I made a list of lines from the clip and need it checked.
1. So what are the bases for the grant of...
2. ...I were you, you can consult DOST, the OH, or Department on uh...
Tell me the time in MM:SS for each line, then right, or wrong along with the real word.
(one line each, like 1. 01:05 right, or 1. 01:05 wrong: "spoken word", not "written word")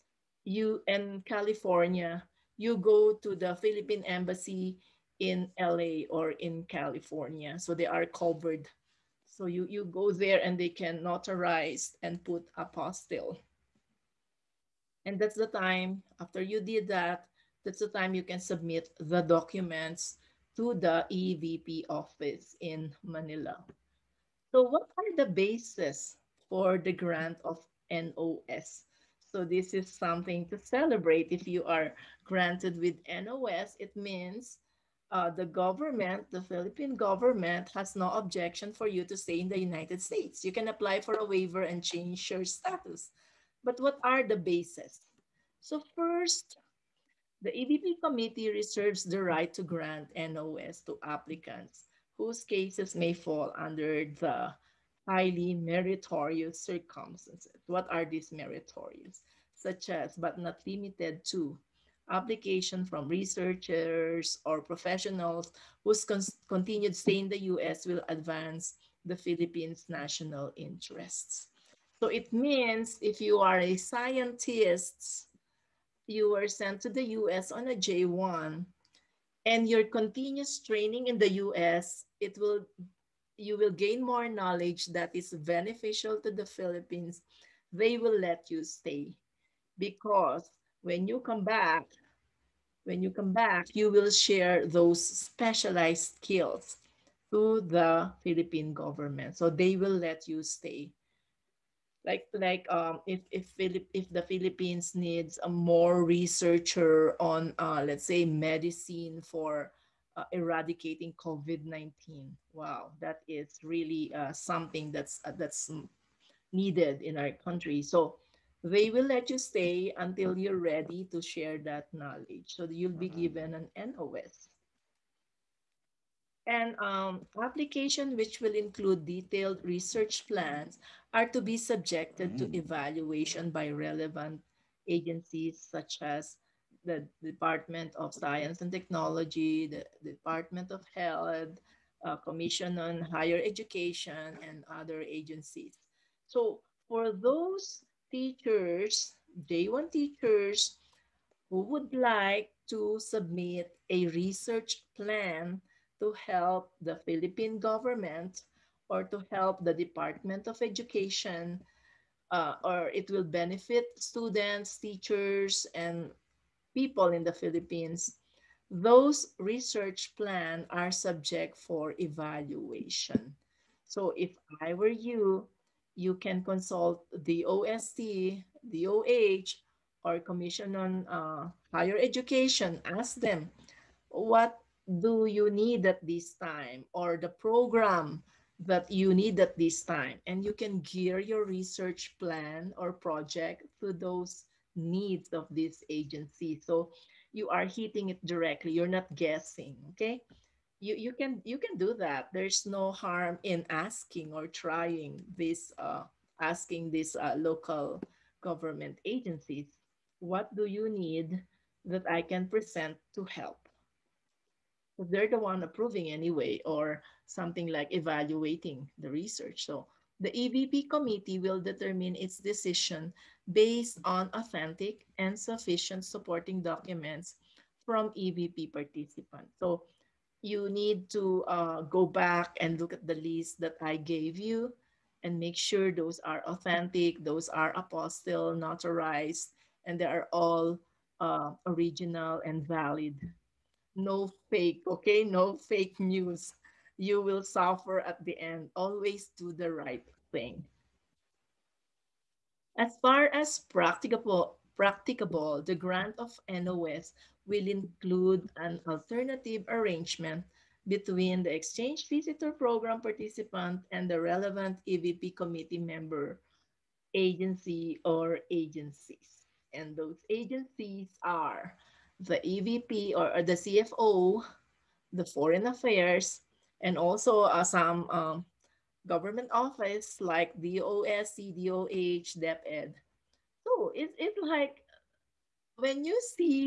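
1. 00:24 right
2. 02:54 wrong: "Commission", not "Department".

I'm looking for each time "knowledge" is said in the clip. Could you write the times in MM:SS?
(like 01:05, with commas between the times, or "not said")
01:24, 02:01.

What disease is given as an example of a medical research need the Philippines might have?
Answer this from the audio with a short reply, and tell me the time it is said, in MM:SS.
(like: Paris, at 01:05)
COVID-19, at 01:51.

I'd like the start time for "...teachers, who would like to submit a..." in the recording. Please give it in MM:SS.
02:29.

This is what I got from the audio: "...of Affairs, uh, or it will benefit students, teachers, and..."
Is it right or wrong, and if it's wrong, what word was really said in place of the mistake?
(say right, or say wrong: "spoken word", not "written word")
wrong: "Education", not "Affairs".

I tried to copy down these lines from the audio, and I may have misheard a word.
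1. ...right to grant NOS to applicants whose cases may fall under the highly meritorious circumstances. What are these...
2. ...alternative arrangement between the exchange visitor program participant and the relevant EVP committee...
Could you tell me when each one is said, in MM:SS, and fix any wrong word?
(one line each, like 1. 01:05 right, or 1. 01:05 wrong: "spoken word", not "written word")
1. 00:49 right
2. 04:18 right.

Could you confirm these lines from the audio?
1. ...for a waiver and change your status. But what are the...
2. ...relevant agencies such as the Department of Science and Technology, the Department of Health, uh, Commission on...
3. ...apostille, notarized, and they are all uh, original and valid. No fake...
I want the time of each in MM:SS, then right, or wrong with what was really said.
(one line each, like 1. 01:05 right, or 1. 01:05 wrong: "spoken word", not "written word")
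1. 00:41 right
2. 02:13 right
3. 03:57 right.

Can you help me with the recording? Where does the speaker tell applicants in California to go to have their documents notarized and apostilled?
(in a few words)
Philippine embassy in LA.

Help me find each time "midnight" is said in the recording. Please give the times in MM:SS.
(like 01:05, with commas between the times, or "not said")
not said.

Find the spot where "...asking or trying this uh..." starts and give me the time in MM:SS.
03:23.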